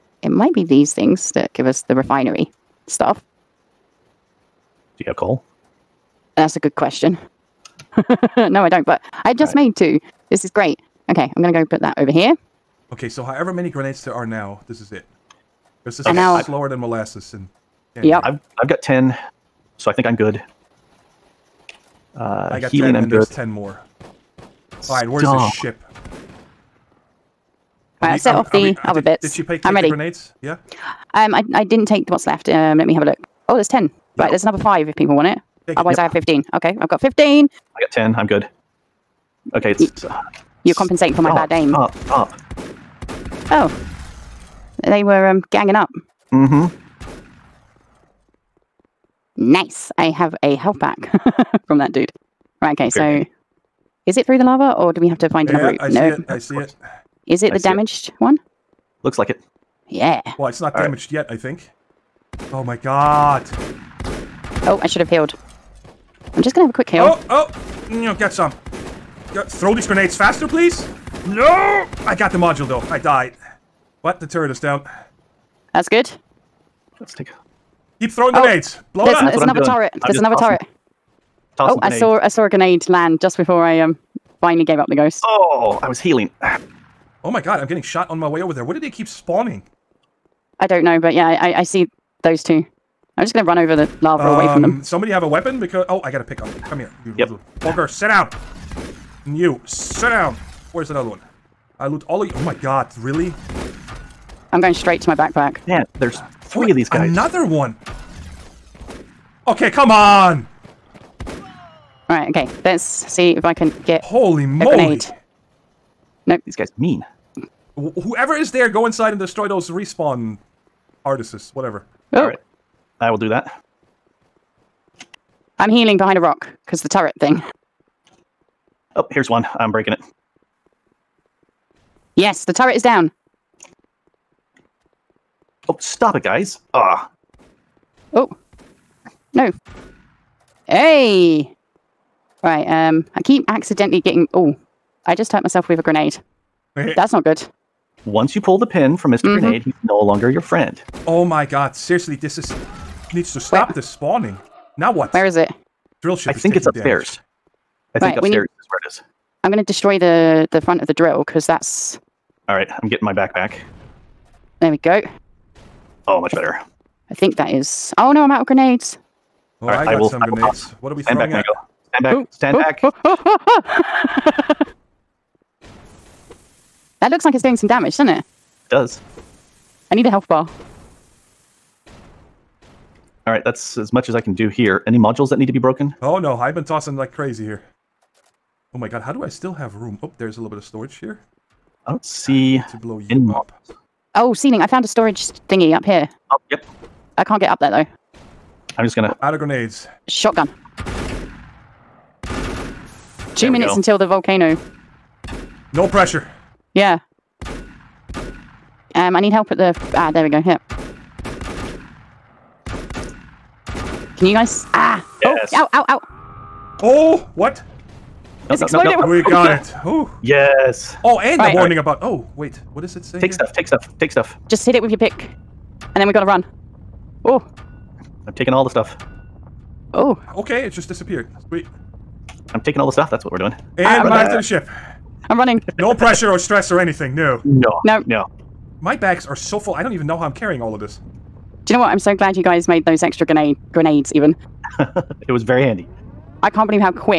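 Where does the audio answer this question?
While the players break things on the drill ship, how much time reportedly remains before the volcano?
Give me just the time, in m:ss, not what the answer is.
3:23.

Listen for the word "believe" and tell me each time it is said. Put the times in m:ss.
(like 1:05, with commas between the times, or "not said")
4:06.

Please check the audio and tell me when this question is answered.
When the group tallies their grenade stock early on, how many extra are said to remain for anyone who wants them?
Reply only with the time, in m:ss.
0:34.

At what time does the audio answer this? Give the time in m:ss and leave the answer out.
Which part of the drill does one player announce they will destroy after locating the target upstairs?
2:40.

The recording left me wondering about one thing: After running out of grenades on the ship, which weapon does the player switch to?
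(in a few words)
Shotgun.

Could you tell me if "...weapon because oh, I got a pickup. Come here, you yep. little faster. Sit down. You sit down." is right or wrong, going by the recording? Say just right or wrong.
wrong.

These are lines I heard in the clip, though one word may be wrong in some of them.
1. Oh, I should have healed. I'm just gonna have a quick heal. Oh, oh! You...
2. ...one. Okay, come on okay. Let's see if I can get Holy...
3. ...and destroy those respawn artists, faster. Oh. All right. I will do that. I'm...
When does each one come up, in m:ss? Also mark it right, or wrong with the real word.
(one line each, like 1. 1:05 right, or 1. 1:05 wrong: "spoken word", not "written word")
1. 1:04 right
2. 1:47 right
3. 1:59 wrong: "whatever", not "faster".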